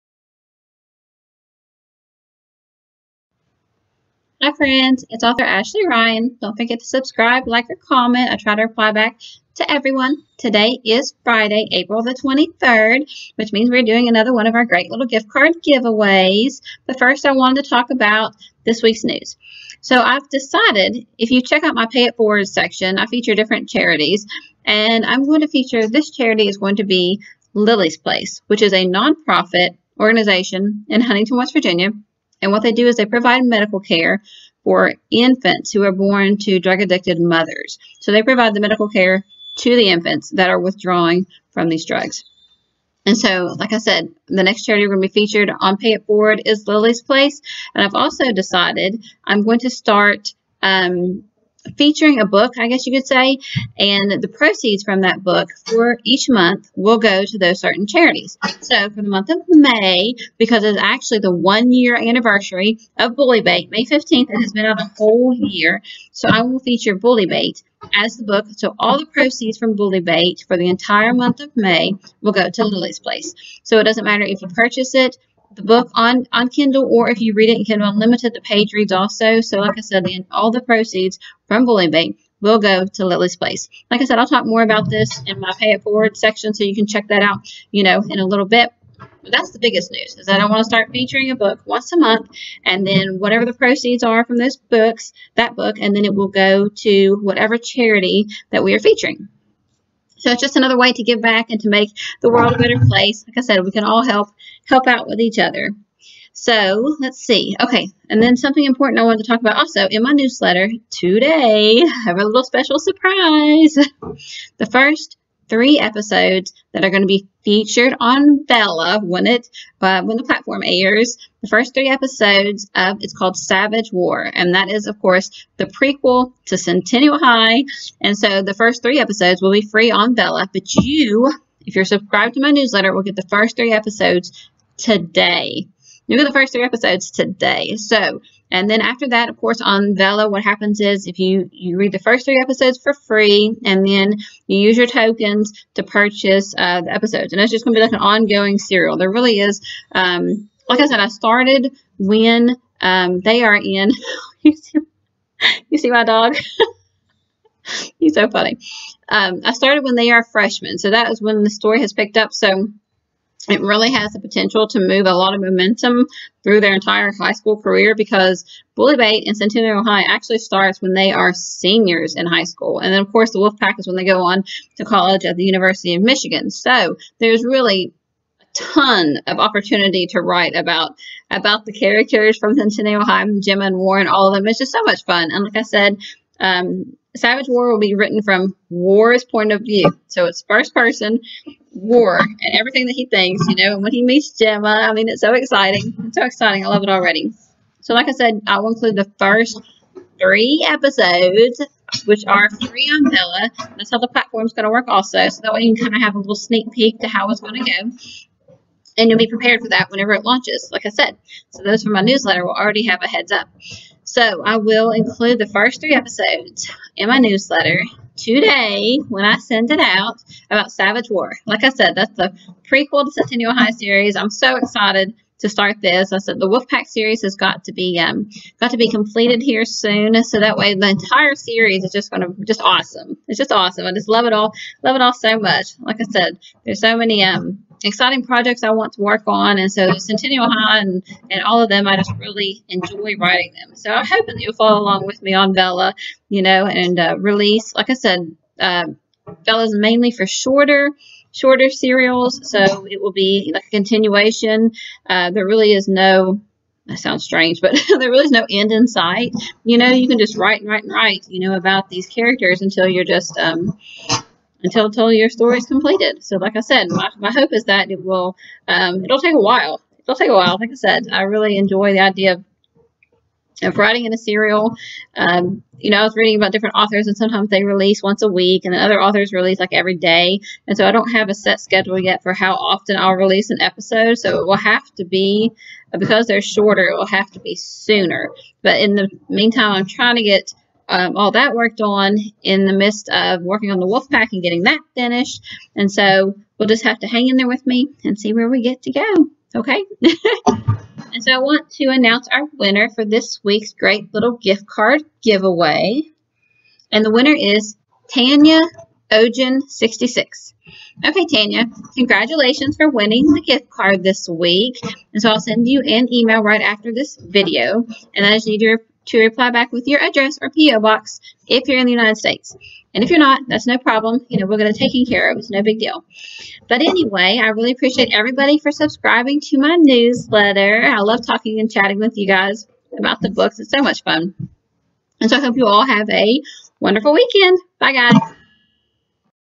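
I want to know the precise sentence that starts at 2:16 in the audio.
Look at the first three episodes today.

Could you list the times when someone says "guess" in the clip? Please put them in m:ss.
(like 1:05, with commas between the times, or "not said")
0:52.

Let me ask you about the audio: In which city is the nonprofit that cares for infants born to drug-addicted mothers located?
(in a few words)
Huntington.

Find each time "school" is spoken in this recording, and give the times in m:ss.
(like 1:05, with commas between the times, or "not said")
2:47, 2:52.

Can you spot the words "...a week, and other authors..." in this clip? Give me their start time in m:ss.
4:38.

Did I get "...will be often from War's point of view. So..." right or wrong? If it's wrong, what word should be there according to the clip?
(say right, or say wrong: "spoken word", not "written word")
wrong: "written", not "often".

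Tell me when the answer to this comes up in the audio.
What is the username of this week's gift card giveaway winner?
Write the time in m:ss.
5:08.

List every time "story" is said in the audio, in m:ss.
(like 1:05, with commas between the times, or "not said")
2:41, 4:25.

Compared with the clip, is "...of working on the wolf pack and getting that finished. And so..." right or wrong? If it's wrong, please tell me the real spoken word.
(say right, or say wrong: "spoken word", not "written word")
right.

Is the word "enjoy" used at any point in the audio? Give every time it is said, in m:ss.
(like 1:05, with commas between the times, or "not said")
4:02, 4:31.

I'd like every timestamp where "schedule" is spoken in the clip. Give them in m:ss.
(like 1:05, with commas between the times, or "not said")
4:41.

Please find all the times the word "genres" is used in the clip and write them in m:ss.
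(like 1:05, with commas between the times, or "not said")
not said.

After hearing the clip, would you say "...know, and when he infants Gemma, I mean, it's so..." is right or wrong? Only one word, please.
wrong.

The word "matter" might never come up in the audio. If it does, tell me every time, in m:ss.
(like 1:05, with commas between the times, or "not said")
1:14.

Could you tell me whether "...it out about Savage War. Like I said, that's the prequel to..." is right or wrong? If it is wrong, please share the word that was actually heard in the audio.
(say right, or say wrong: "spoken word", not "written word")
right.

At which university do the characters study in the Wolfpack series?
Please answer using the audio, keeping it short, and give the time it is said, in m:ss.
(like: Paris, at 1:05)
University of Michigan, at 2:55.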